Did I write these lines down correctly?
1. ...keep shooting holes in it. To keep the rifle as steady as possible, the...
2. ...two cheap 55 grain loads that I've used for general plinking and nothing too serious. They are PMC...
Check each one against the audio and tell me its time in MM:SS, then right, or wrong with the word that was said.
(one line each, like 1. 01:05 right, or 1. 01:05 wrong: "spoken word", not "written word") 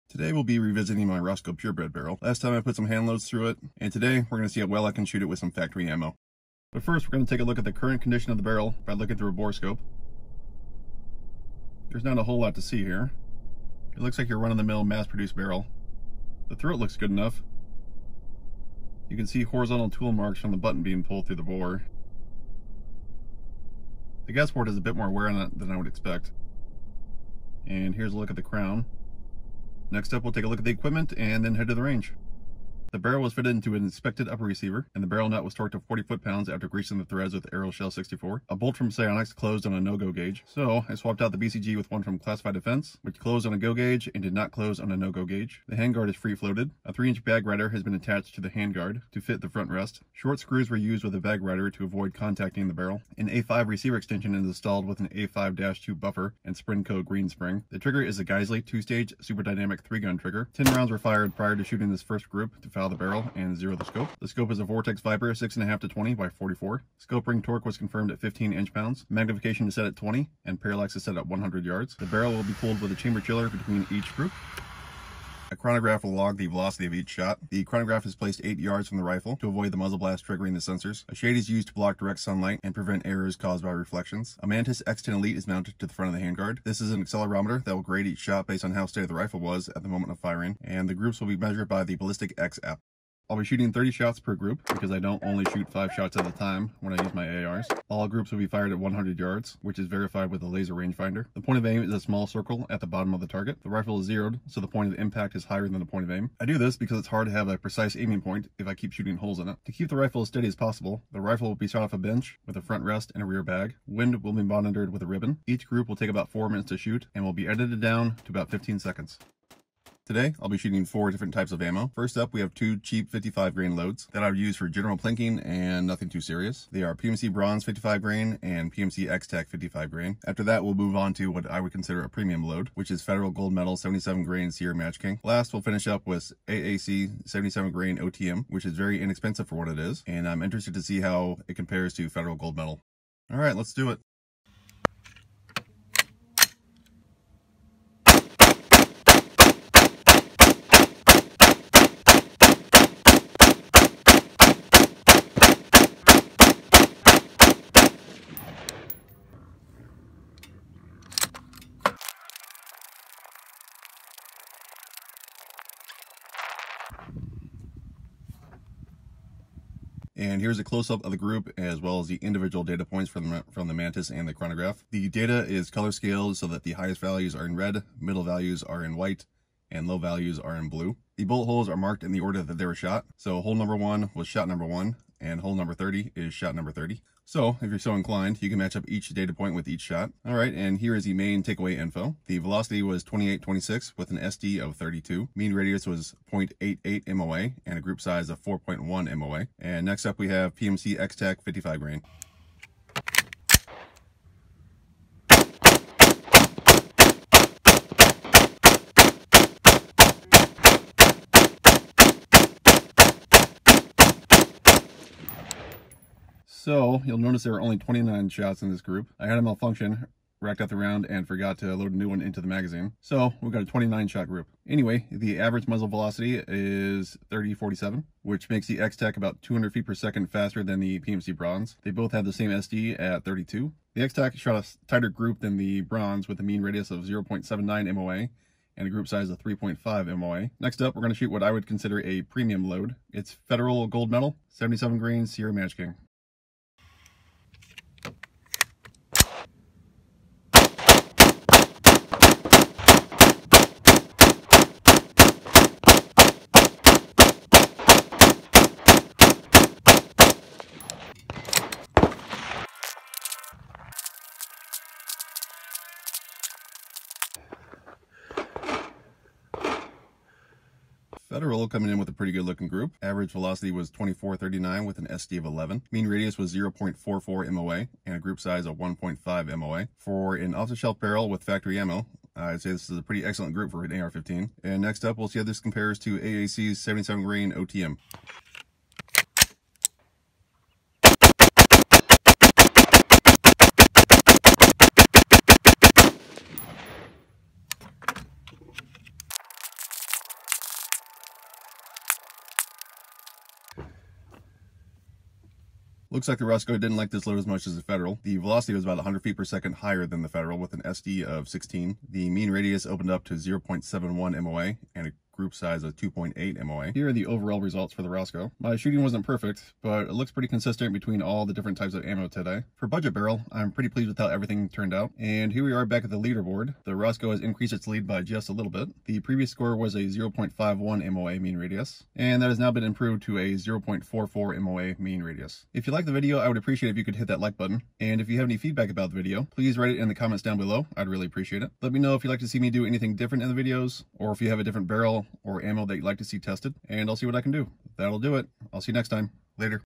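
1. 01:48 right
2. 02:02 right.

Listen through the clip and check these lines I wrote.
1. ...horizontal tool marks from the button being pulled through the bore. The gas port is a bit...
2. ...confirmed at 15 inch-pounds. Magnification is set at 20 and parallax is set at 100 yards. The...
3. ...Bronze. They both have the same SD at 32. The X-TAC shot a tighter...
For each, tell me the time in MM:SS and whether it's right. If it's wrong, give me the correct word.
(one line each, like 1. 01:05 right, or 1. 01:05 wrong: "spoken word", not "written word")
1. 00:19 right
2. 01:07 right
3. 03:51 right.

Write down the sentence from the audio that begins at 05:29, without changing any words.
The previous score was a 0.51 MOA mean radius, and that has now been improved to a 0.44 MOA mean radius.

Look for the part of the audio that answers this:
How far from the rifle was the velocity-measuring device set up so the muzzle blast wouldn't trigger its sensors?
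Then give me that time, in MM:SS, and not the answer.
01:18.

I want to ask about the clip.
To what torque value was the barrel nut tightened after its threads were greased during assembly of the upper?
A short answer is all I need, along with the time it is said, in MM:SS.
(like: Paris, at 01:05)
40 foot-pounds, at 00:35.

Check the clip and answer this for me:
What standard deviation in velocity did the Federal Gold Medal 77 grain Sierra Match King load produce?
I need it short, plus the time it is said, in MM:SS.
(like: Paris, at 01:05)
11, at 04:35.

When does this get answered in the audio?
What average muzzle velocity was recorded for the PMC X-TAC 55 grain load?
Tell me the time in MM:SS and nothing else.
03:47.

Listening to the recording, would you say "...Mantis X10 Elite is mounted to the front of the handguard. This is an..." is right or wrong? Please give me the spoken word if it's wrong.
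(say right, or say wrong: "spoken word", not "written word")
right.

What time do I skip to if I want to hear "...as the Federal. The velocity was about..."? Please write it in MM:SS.
05:07.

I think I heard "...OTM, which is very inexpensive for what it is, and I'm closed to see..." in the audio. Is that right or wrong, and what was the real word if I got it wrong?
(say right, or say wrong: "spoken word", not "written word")
wrong: "interested", not "closed".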